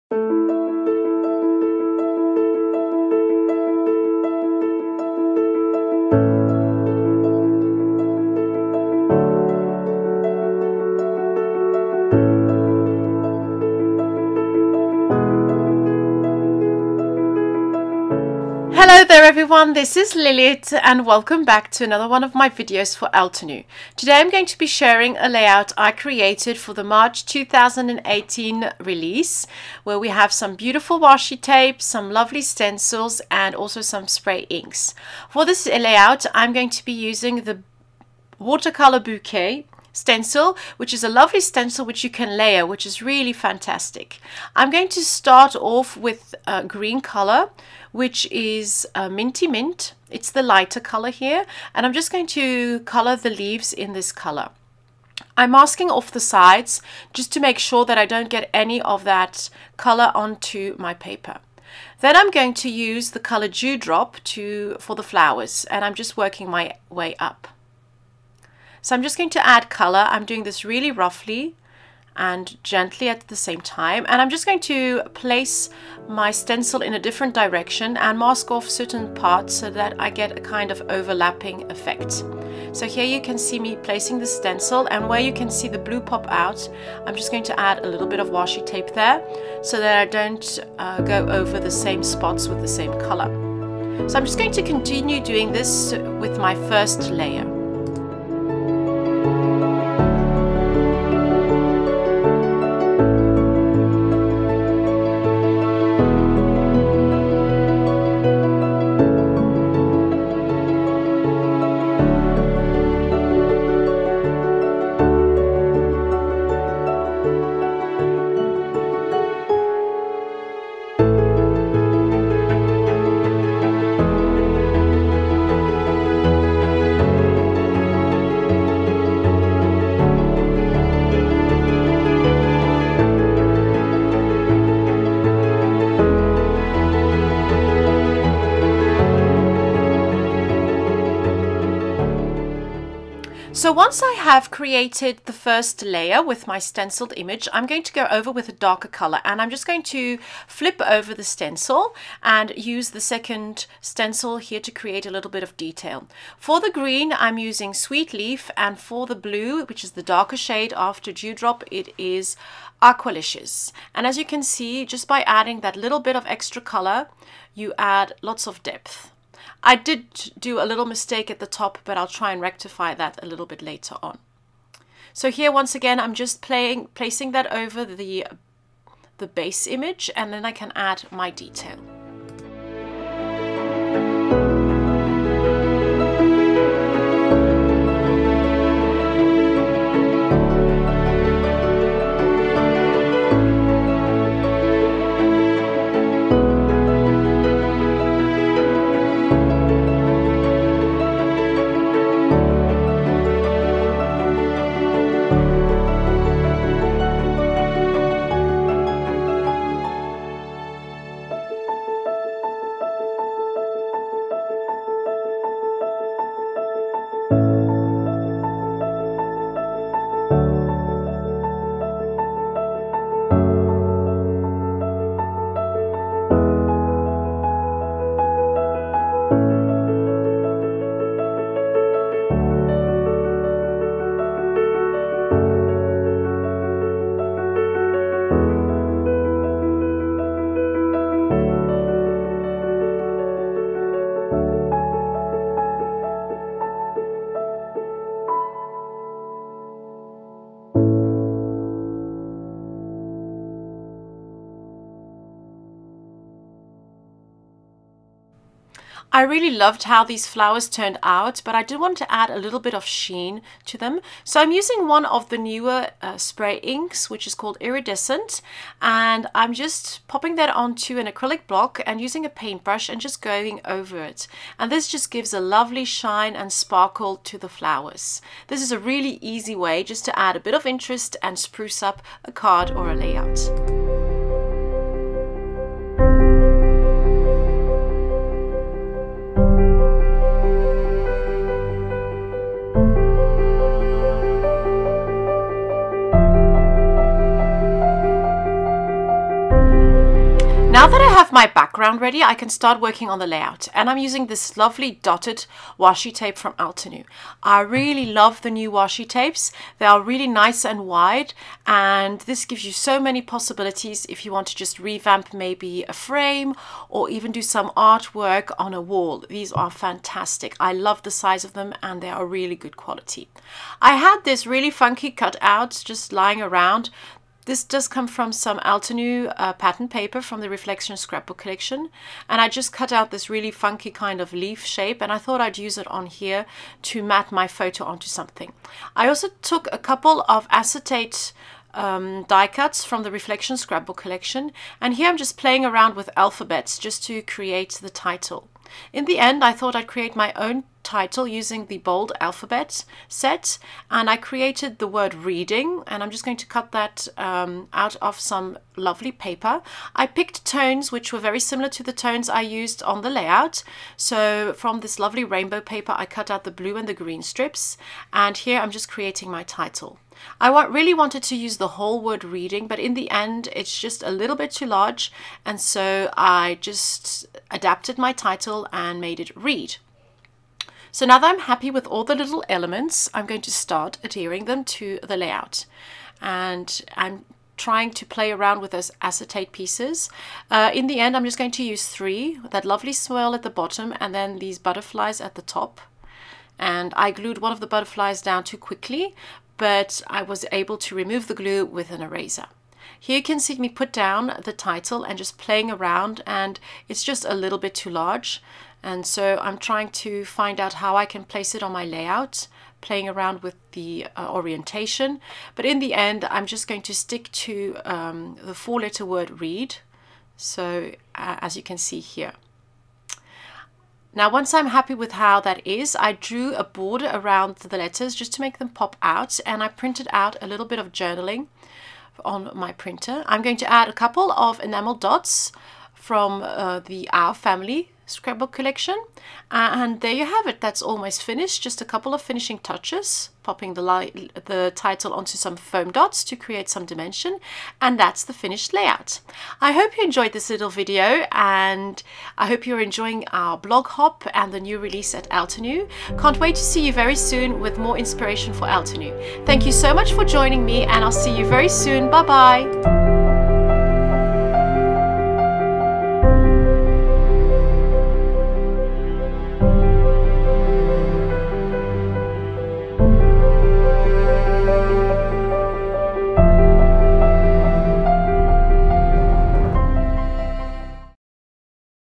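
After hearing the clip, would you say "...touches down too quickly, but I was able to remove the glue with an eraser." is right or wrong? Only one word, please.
wrong.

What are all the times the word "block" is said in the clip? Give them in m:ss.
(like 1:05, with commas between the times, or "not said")
4:31.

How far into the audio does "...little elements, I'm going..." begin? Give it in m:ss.
6:22.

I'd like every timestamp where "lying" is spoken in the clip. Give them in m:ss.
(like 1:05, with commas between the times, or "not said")
5:26.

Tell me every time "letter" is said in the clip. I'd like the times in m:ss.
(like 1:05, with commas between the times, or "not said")
6:58, 7:07.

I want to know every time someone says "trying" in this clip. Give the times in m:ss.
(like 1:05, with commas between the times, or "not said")
6:27, 6:49.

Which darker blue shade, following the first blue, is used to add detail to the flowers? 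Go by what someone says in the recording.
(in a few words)
Aqualicious.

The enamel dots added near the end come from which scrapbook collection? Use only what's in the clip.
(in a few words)
Our Family.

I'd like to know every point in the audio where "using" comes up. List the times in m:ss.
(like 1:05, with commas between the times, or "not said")
0:36, 2:37, 4:24, 4:31, 5:03, 5:51.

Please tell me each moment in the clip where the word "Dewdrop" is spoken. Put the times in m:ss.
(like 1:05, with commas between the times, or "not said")
1:03, 2:41.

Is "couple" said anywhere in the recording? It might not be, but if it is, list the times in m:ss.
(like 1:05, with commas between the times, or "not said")
5:39, 7:13, 7:21.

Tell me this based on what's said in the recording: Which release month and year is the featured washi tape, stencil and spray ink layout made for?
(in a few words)
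March 2018.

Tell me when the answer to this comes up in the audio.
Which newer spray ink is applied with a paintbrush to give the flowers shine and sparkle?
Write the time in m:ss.
4:27.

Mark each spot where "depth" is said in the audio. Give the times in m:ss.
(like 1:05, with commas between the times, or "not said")
2:48.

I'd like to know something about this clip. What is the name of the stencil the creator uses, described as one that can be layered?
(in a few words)
Watercolor Bouquet.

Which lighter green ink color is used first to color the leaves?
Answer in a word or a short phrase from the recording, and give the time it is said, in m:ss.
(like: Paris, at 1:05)
Minty Mint, at 0:49.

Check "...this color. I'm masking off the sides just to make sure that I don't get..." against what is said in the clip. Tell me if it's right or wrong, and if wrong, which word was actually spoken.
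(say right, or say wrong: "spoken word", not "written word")
right.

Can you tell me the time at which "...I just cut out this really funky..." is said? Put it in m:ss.
5:32.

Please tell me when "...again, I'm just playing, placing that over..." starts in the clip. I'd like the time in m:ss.
2:55.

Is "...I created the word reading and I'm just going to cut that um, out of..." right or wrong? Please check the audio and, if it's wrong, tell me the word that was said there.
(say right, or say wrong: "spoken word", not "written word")
right.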